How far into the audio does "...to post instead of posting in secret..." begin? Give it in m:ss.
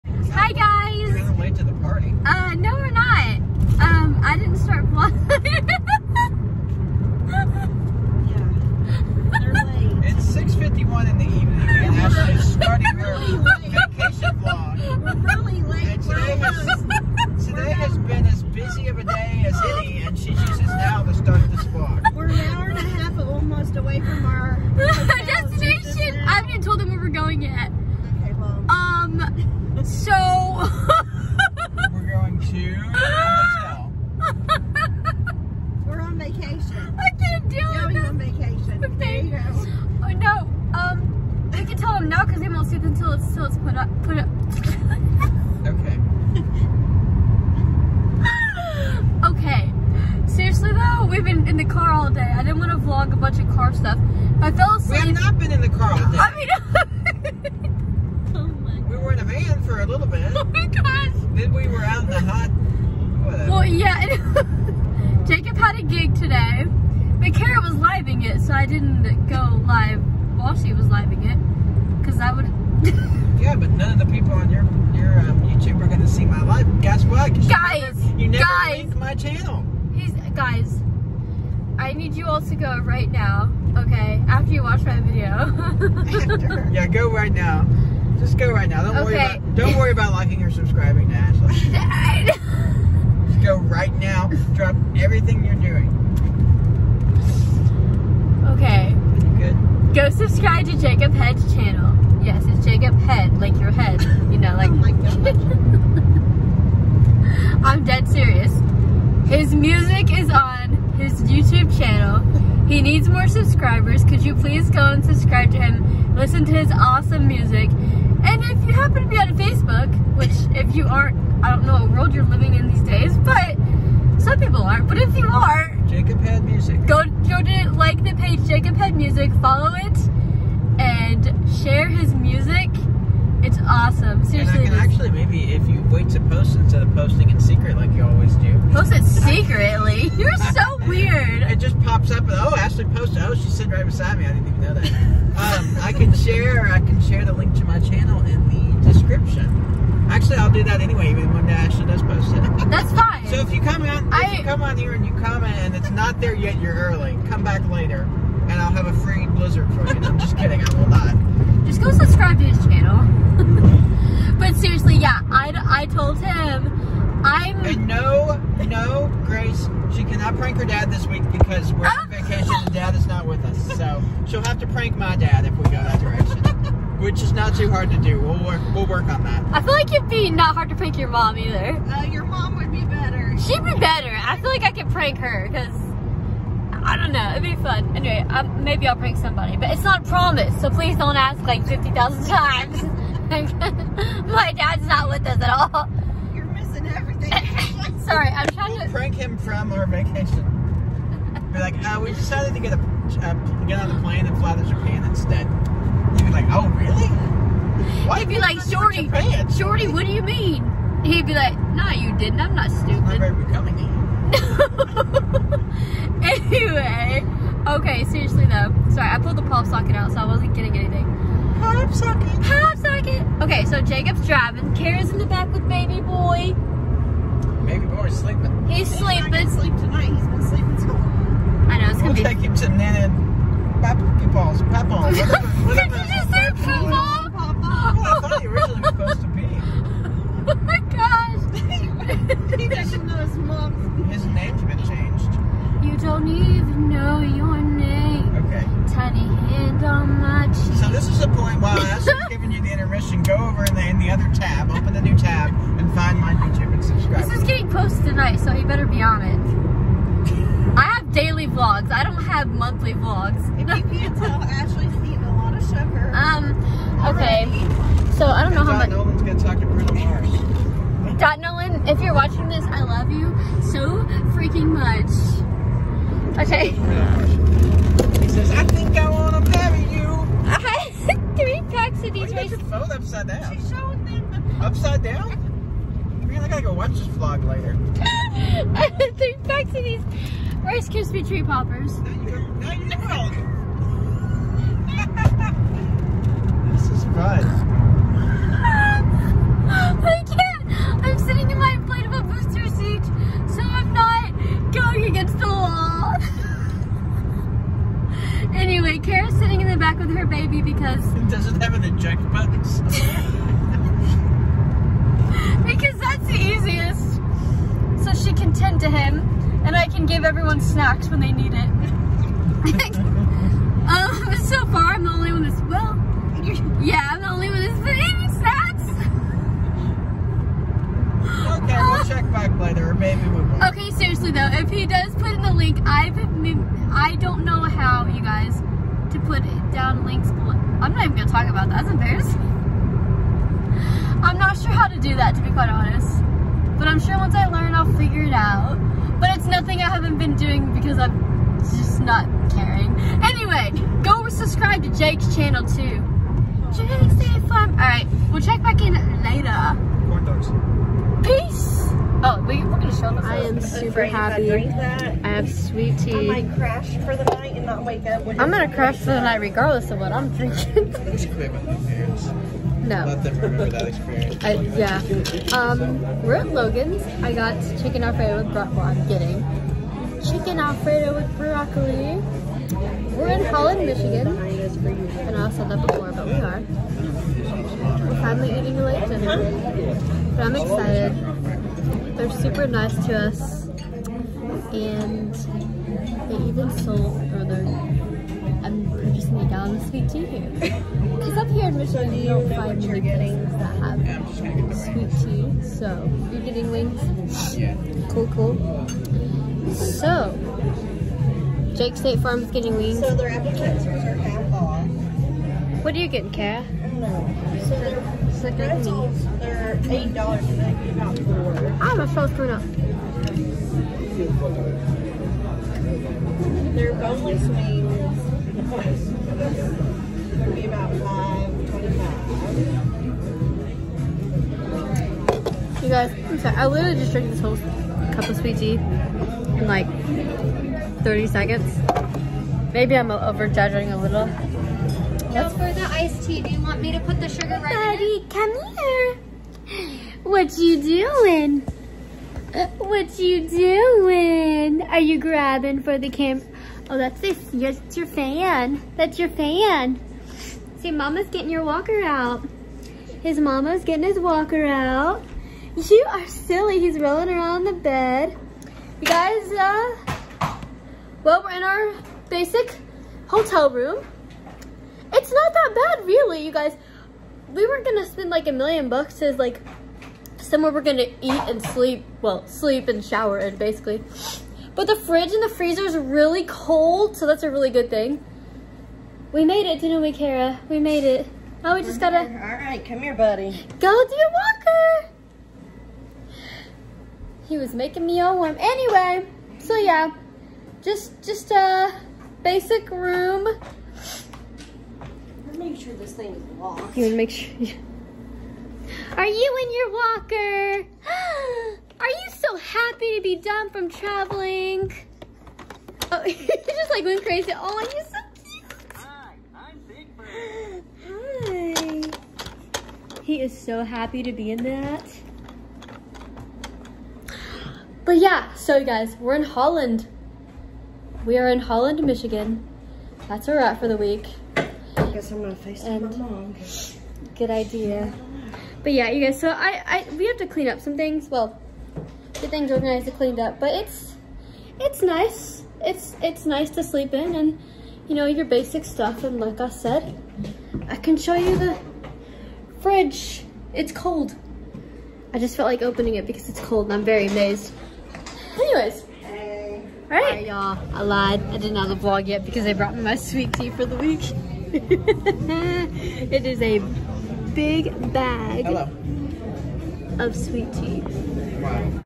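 2:16.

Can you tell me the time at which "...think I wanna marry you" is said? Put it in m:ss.
4:38.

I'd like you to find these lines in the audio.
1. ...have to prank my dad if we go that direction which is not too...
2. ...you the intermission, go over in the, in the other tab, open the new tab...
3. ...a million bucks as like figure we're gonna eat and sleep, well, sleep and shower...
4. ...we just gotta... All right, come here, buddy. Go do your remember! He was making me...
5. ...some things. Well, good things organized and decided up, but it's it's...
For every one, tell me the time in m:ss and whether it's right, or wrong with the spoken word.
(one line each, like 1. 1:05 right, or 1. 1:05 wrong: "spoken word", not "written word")
1. 2:54 right
2. 4:12 right
3. 7:58 wrong: "somewhere", not "figure"
4. 8:11 wrong: "walker", not "remember"
5. 9:00 wrong: "cleaned", not "decided".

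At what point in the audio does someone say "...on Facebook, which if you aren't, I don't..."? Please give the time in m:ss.
1:59.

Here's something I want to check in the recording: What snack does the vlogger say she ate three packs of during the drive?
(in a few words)
Rice Krispie Tree Poppers.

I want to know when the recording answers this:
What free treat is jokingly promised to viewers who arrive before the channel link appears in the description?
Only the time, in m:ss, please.
2:39.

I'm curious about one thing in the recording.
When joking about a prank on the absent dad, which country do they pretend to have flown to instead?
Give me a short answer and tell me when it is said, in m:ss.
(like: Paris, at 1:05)
Japan, at 3:24.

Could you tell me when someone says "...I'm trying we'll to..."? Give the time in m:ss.
3:18.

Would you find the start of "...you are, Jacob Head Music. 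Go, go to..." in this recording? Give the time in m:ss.
2:05.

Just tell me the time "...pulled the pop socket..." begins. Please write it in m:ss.
3:39.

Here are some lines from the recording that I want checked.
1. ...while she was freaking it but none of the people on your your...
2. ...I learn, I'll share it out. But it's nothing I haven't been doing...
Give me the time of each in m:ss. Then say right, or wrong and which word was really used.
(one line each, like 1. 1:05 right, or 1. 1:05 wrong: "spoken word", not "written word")
1. 1:10 wrong: "living", not "freaking"
2. 5:47 wrong: "figure", not "share".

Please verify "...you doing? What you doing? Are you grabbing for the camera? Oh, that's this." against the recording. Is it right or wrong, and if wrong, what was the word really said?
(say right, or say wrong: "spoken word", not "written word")
right.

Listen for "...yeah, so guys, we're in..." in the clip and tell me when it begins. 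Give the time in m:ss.
8:48.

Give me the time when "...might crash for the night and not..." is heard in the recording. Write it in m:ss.
6:06.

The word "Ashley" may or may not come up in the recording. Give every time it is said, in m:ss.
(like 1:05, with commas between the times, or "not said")
1:31, 2:22, 2:31, 4:24.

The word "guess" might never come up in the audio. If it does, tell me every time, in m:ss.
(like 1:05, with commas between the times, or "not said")
1:16, 8:55.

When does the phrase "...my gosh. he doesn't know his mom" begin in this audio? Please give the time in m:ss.
4:00.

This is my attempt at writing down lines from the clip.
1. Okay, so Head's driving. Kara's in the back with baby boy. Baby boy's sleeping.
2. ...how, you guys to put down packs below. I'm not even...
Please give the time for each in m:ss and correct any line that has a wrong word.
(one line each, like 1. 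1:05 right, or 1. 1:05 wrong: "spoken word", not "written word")
1. 3:43 wrong: "Jacob", not "Head"
2. 5:37 wrong: "links", not "packs".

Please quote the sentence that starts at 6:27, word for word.
We're finally eating a late dinner.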